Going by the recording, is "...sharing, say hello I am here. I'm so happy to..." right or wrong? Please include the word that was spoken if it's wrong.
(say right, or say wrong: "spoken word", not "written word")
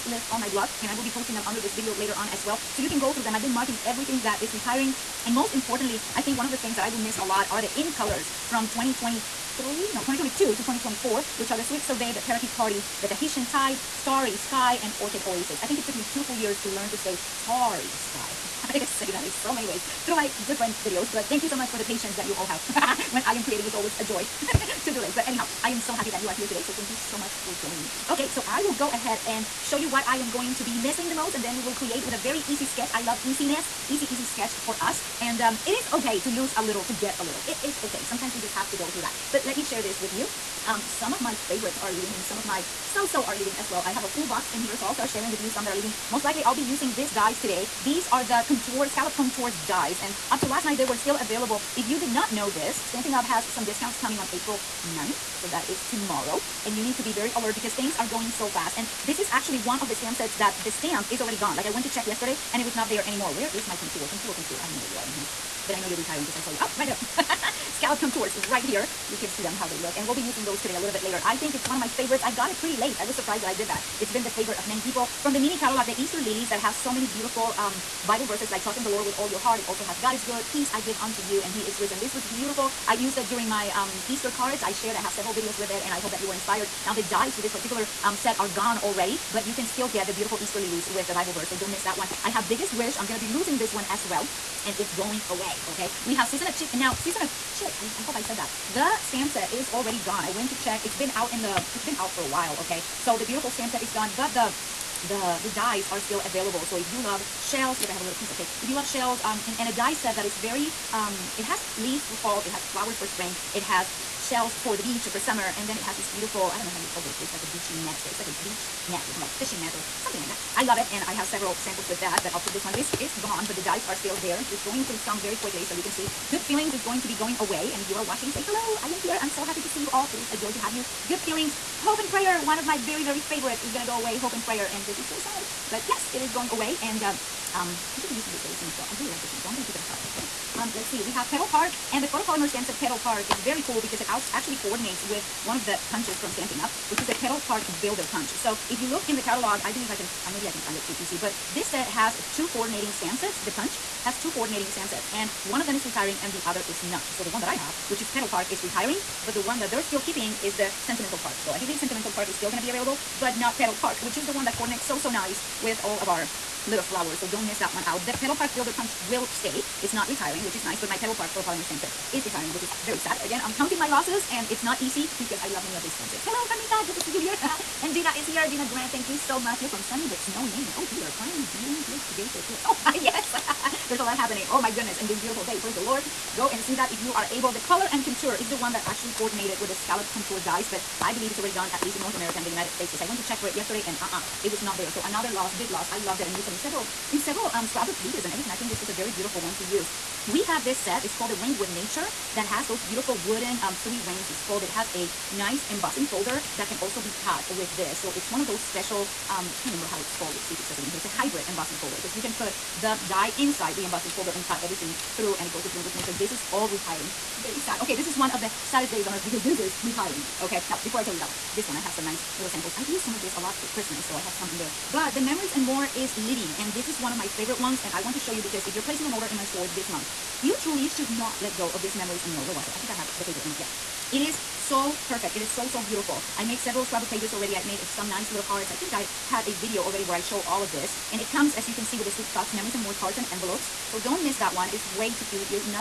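wrong: "watching", not "sharing".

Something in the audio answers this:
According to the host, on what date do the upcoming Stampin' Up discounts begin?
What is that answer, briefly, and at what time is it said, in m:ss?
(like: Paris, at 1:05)
April 9th, at 0:54.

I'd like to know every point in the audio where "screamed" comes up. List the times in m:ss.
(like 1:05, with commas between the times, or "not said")
not said.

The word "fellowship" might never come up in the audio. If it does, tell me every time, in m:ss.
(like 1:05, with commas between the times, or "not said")
not said.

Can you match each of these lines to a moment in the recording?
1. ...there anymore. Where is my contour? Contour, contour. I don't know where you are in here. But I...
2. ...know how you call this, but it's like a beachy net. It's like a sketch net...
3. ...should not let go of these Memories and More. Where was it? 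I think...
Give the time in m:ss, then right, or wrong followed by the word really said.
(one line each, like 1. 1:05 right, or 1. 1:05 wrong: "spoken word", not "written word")
1. 1:02 right
2. 1:56 wrong: "beach", not "sketch"
3. 3:50 right.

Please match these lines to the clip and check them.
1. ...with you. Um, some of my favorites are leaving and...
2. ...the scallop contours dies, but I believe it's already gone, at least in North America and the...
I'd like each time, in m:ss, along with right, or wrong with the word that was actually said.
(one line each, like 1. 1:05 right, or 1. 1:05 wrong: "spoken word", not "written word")
1. 0:39 right
2. 3:09 right.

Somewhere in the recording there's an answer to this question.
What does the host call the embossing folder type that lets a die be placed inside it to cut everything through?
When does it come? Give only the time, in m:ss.
3:31.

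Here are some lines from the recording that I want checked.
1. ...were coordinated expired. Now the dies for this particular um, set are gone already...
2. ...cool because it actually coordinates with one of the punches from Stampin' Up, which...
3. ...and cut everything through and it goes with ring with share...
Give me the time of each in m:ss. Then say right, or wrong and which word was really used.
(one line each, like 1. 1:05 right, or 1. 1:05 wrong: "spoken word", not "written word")
1. 1:26 wrong: "inspired", not "coordinated"
2. 2:23 right
3. 3:34 wrong: "nature", not "share".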